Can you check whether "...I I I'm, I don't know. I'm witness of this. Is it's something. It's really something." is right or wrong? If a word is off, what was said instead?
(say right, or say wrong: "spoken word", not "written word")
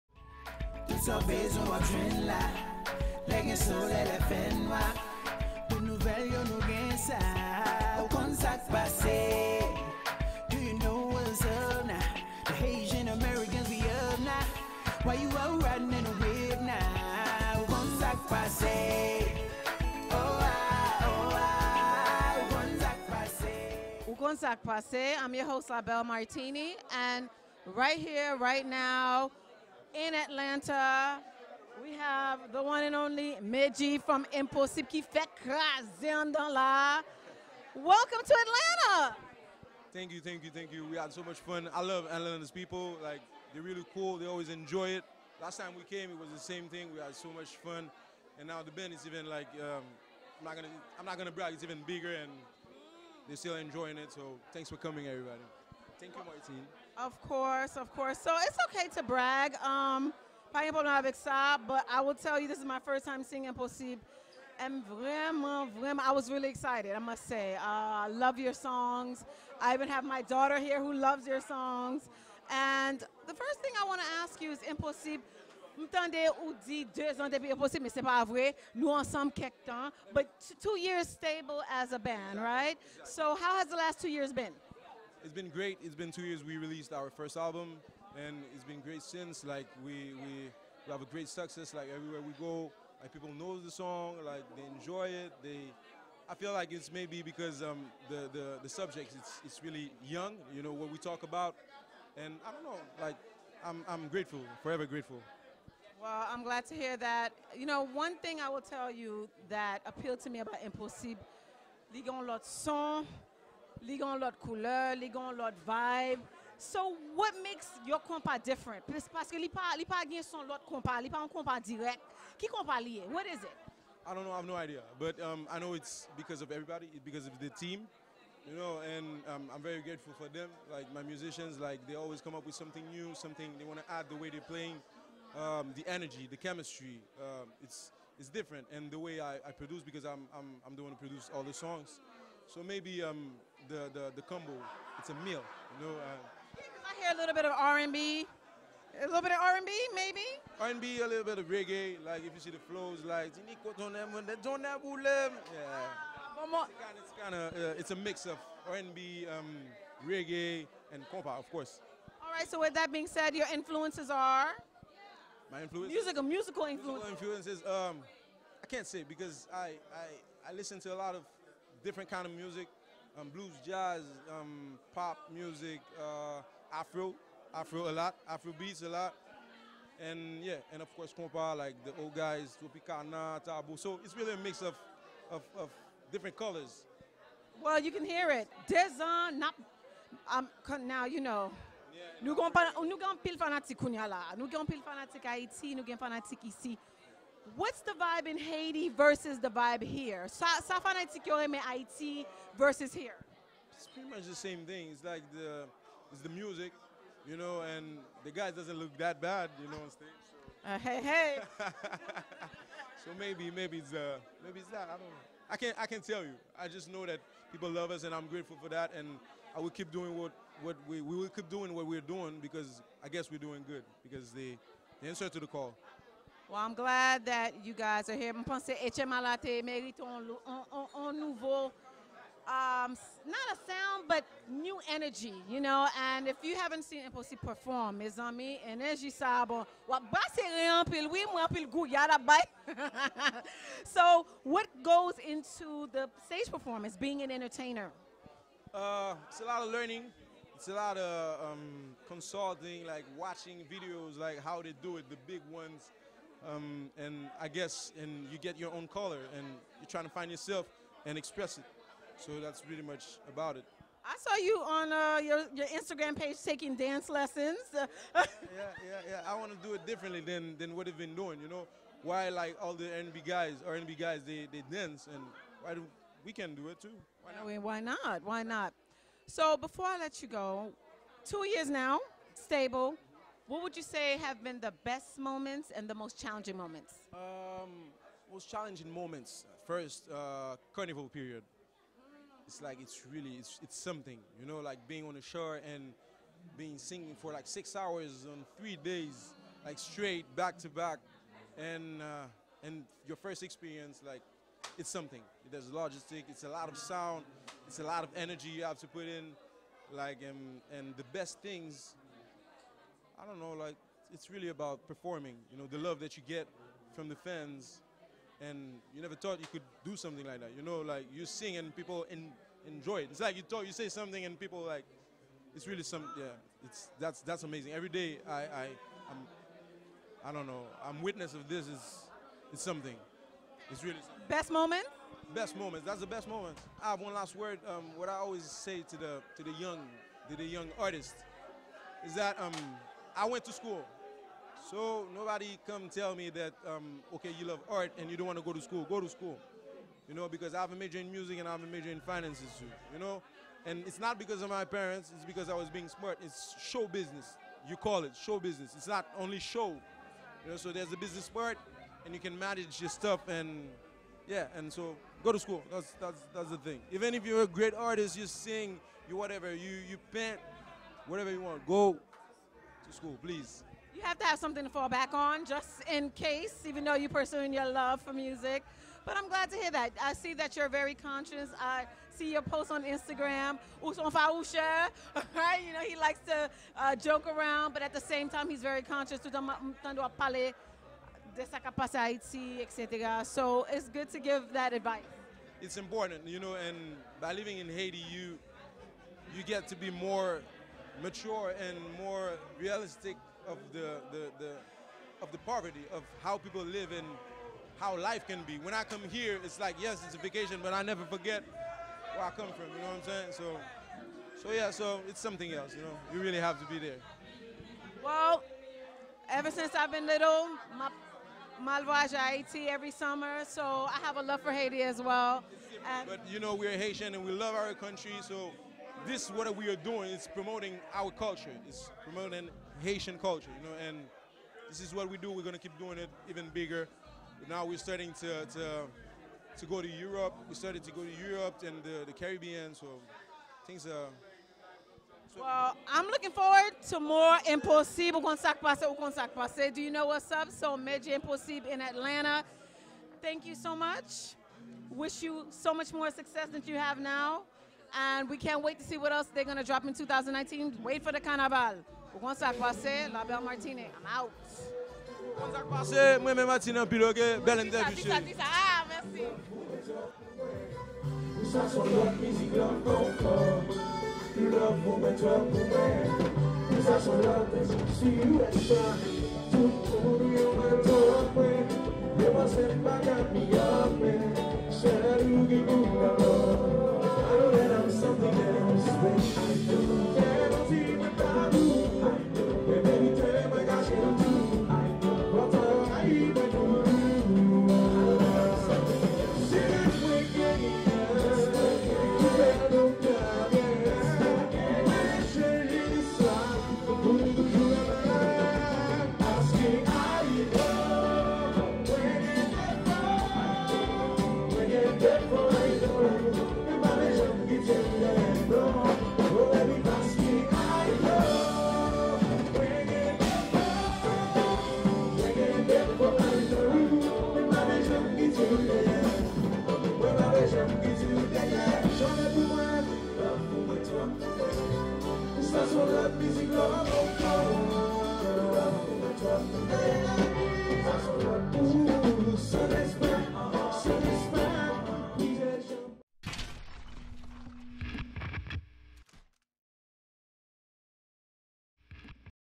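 right.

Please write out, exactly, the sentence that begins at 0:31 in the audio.
We have the one and only Medjy from Enposib qui fait craser en dans là.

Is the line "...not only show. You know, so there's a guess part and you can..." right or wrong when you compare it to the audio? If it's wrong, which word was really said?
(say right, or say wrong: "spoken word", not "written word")
wrong: "business", not "guess".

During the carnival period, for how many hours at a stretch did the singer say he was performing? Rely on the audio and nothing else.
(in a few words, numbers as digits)
6 hours.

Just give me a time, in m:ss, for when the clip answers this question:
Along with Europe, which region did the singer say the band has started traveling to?
7:22.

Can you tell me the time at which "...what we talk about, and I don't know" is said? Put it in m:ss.
1:40.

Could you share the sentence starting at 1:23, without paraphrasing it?
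So how has the last two years been?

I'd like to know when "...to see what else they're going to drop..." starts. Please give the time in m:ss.
7:38.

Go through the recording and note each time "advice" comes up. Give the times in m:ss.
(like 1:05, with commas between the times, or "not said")
6:34.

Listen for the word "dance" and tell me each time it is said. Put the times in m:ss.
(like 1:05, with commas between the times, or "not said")
4:26, 4:34.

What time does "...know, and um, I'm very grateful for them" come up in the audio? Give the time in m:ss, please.
2:08.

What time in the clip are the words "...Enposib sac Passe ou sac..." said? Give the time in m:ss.
7:27.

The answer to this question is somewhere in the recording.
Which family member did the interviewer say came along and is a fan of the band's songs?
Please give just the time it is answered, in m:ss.
1:10.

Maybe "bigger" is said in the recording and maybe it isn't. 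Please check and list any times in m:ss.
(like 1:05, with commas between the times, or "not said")
0:51, 7:16.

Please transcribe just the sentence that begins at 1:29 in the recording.
Like we we, we have a great success.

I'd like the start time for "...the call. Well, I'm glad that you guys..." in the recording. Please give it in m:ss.
3:45.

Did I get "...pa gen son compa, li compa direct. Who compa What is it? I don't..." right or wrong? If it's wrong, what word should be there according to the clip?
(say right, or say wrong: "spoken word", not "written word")
right.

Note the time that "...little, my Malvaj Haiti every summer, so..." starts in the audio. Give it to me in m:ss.
7:00.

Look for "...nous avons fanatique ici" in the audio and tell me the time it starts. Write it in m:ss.
3:15.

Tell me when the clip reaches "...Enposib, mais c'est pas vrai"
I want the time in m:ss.
1:17.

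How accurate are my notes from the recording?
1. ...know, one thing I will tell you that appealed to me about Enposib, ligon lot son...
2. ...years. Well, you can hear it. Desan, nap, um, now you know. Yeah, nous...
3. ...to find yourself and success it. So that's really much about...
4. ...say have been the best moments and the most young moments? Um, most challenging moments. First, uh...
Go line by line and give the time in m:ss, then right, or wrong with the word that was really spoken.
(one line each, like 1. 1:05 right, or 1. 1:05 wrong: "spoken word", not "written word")
1. 1:47 right
2. 3:06 wrong: "colors", not "years"
3. 4:20 wrong: "express", not "success"
4. 4:43 wrong: "challenging", not "young".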